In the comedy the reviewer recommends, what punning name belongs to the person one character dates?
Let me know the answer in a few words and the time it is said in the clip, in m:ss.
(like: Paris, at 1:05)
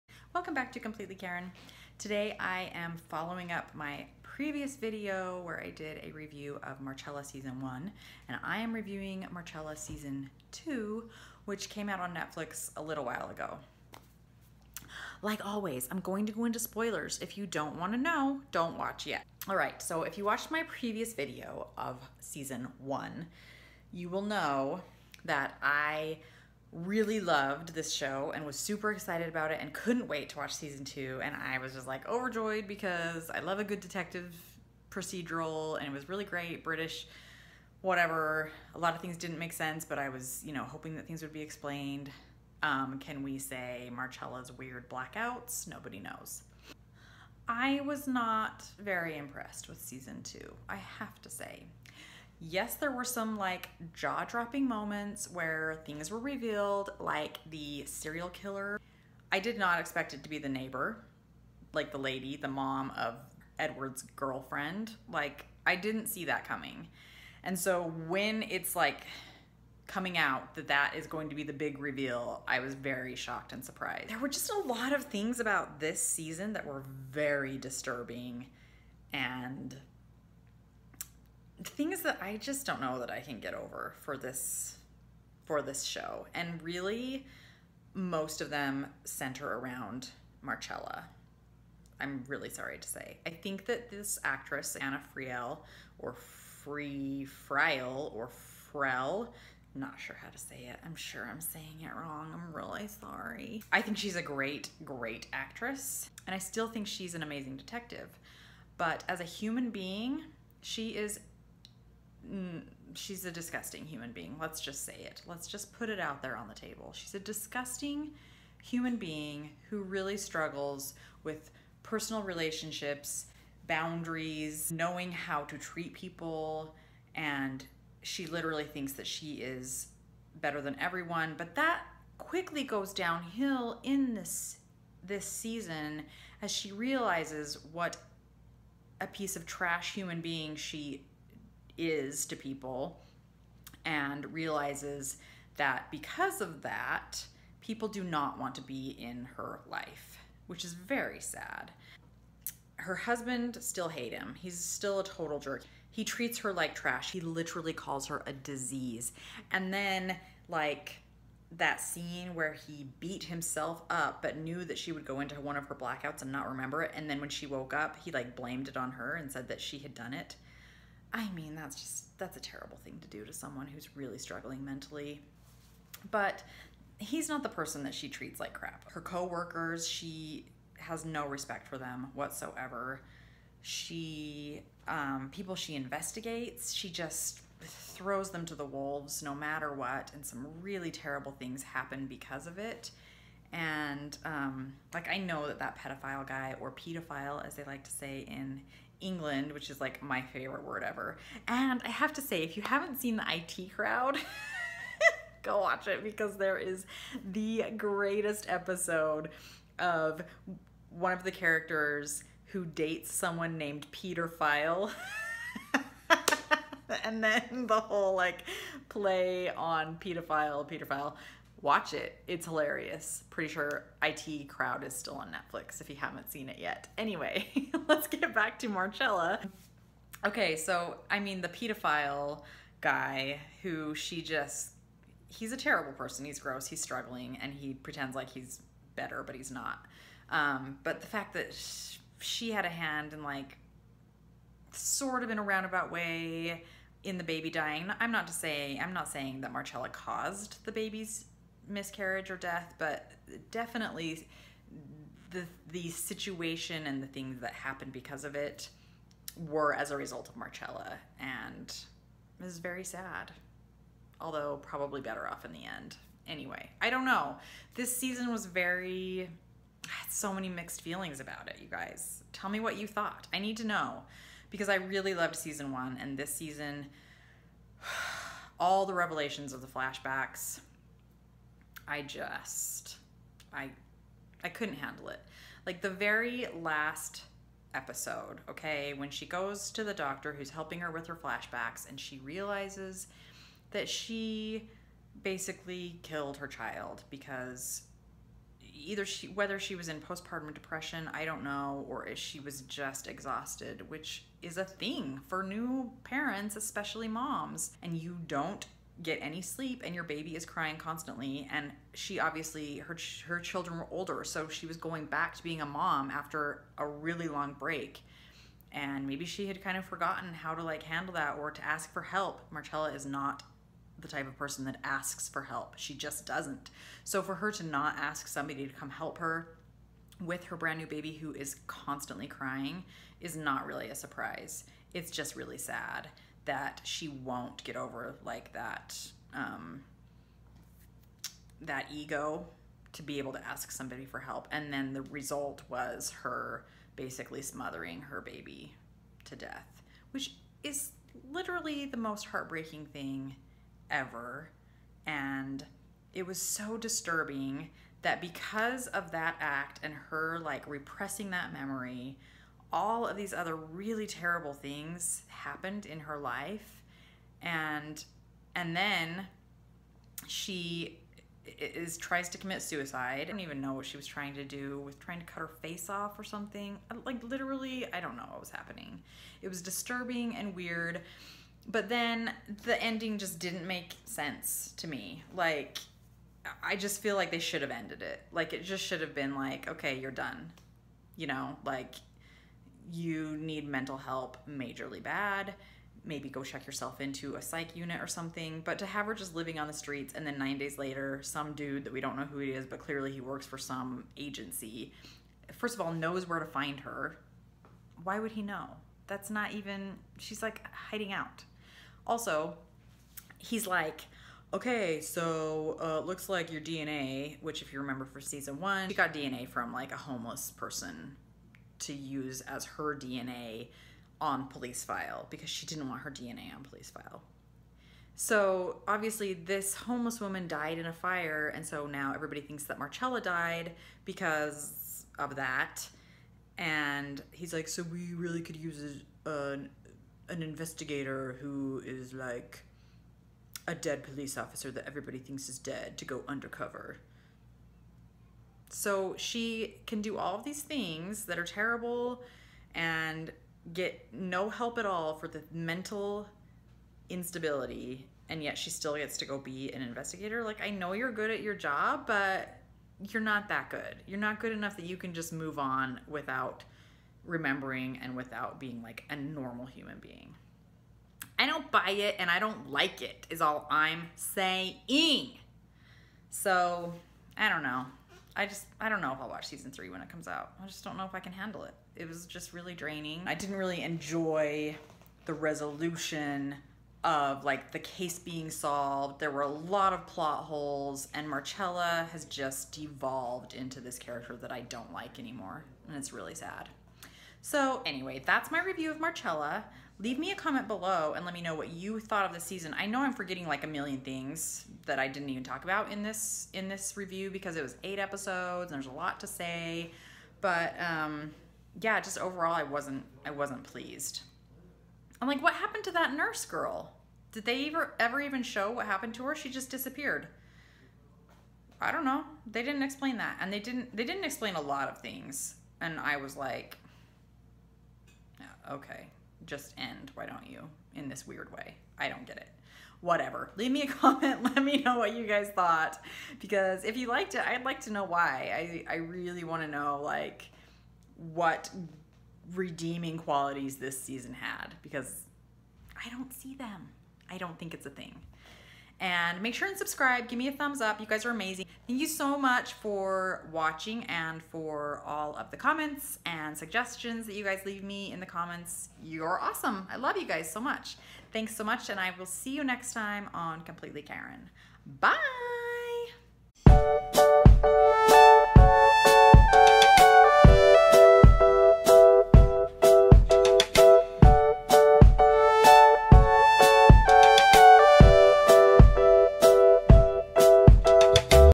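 Peter File, at 3:33.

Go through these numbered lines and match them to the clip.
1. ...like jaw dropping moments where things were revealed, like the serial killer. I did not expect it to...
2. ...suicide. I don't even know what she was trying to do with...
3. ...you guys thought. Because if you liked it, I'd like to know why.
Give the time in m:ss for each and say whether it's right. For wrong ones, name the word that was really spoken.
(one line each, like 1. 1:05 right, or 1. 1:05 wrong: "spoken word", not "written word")
1. 0:53 right
2. 6:12 right
3. 8:55 right.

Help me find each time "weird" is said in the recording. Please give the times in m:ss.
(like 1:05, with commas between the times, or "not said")
0:44, 6:20, 8:51.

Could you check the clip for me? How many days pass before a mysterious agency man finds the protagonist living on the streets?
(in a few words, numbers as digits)
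9.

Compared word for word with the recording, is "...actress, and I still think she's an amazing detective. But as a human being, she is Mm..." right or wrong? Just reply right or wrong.
right.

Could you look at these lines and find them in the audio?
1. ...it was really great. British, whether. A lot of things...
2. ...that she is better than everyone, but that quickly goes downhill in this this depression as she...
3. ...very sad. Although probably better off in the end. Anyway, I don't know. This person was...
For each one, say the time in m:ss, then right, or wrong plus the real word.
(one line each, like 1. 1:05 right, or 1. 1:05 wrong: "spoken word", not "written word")
1. 0:35 wrong: "whatever", not "whether"
2. 2:08 wrong: "season", not "depression"
3. 4:22 wrong: "season", not "person".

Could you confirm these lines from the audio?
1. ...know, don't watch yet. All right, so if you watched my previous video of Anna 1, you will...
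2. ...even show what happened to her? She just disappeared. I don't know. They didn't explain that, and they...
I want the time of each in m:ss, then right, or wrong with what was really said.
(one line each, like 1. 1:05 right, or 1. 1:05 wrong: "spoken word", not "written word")
1. 0:17 wrong: "Season", not "Anna"
2. 8:38 right.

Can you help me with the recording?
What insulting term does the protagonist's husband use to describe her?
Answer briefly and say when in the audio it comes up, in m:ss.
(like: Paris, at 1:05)
a disease, at 2:38.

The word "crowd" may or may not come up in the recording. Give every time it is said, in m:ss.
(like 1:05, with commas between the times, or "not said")
3:23, 3:44.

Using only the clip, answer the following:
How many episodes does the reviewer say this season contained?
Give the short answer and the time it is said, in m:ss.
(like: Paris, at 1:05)
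8, at 8:27.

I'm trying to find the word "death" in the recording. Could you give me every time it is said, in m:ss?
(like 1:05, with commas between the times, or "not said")
4:12, 5:49.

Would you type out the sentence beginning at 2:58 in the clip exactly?
Her coworkers, she has no respect for them whatsoever.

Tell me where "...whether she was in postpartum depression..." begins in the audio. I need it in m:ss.
4:59.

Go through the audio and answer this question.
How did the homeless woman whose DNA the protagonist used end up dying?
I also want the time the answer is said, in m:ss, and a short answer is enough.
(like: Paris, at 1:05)
in a fire, at 7:10.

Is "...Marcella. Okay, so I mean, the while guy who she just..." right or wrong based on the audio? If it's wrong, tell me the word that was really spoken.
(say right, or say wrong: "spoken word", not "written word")
wrong: "pedophile", not "while".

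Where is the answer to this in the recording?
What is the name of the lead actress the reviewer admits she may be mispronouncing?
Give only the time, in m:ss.
1:34.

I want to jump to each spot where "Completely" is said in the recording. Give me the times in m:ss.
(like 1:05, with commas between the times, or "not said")
0:00, 9:23.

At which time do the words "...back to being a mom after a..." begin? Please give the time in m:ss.
5:15.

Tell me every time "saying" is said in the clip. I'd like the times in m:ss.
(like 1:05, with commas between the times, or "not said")
1:41, 4:09, 7:54.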